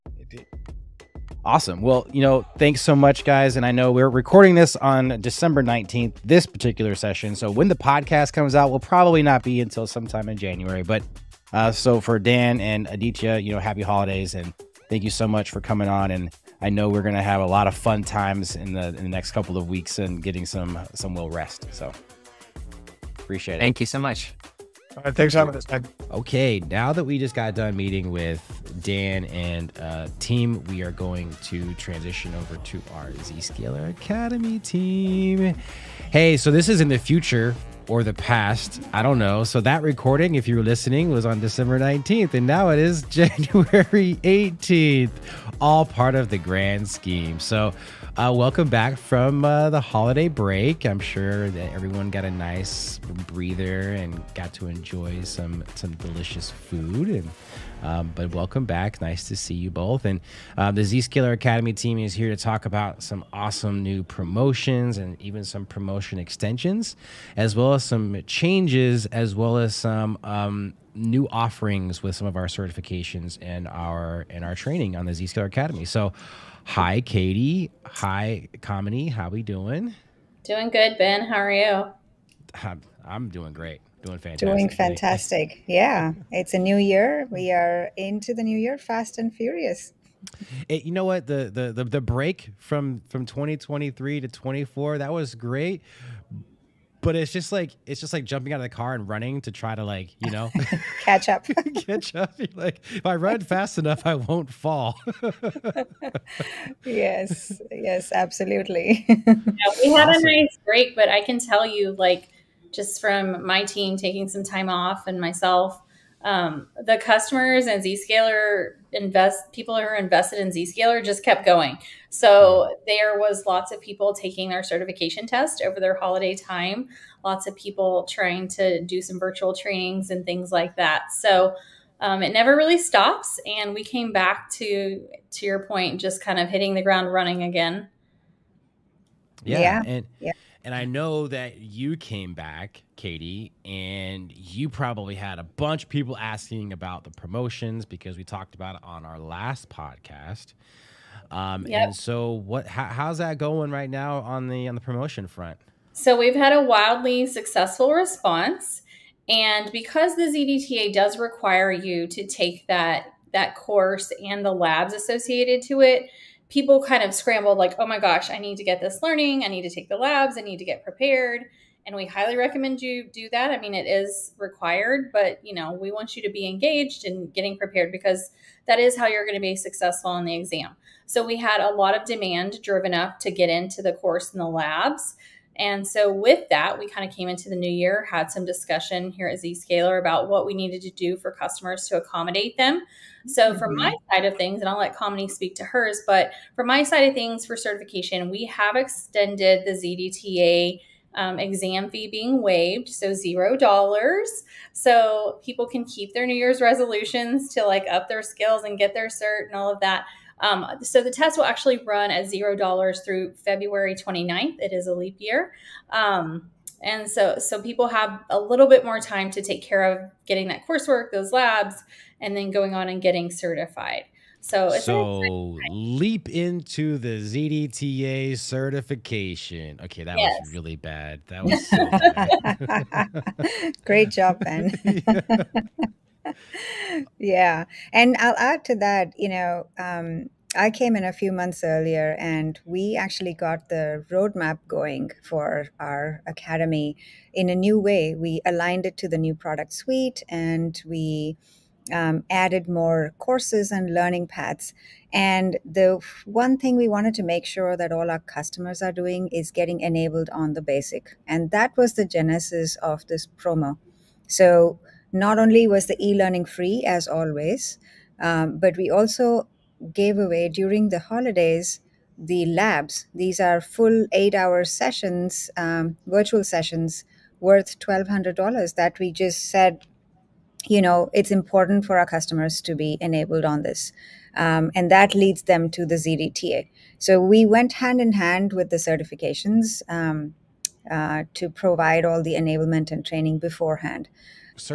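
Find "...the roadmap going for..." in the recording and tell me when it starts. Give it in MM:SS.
04:03.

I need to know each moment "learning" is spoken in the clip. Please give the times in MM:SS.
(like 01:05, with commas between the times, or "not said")
02:49, 04:13, 04:26.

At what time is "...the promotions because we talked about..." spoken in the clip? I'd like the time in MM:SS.
02:27.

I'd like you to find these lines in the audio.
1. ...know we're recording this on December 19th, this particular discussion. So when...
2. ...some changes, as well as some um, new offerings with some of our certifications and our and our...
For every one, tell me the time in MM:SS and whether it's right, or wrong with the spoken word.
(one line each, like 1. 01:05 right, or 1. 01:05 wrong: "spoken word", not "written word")
1. 00:03 wrong: "session", not "discussion"
2. 01:07 right.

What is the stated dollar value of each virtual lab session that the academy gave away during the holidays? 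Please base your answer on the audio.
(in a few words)
$1,200.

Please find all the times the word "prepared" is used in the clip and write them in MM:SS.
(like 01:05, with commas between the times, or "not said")
02:50, 02:57.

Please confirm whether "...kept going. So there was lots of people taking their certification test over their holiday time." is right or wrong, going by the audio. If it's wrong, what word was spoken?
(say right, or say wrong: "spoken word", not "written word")
right.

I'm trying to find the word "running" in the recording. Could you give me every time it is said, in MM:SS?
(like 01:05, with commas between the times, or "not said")
01:39, 02:17.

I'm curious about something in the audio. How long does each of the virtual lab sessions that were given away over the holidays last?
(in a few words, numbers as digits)
8 hours.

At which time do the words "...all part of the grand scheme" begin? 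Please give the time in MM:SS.
00:45.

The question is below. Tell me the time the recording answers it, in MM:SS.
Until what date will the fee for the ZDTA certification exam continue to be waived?
03:33.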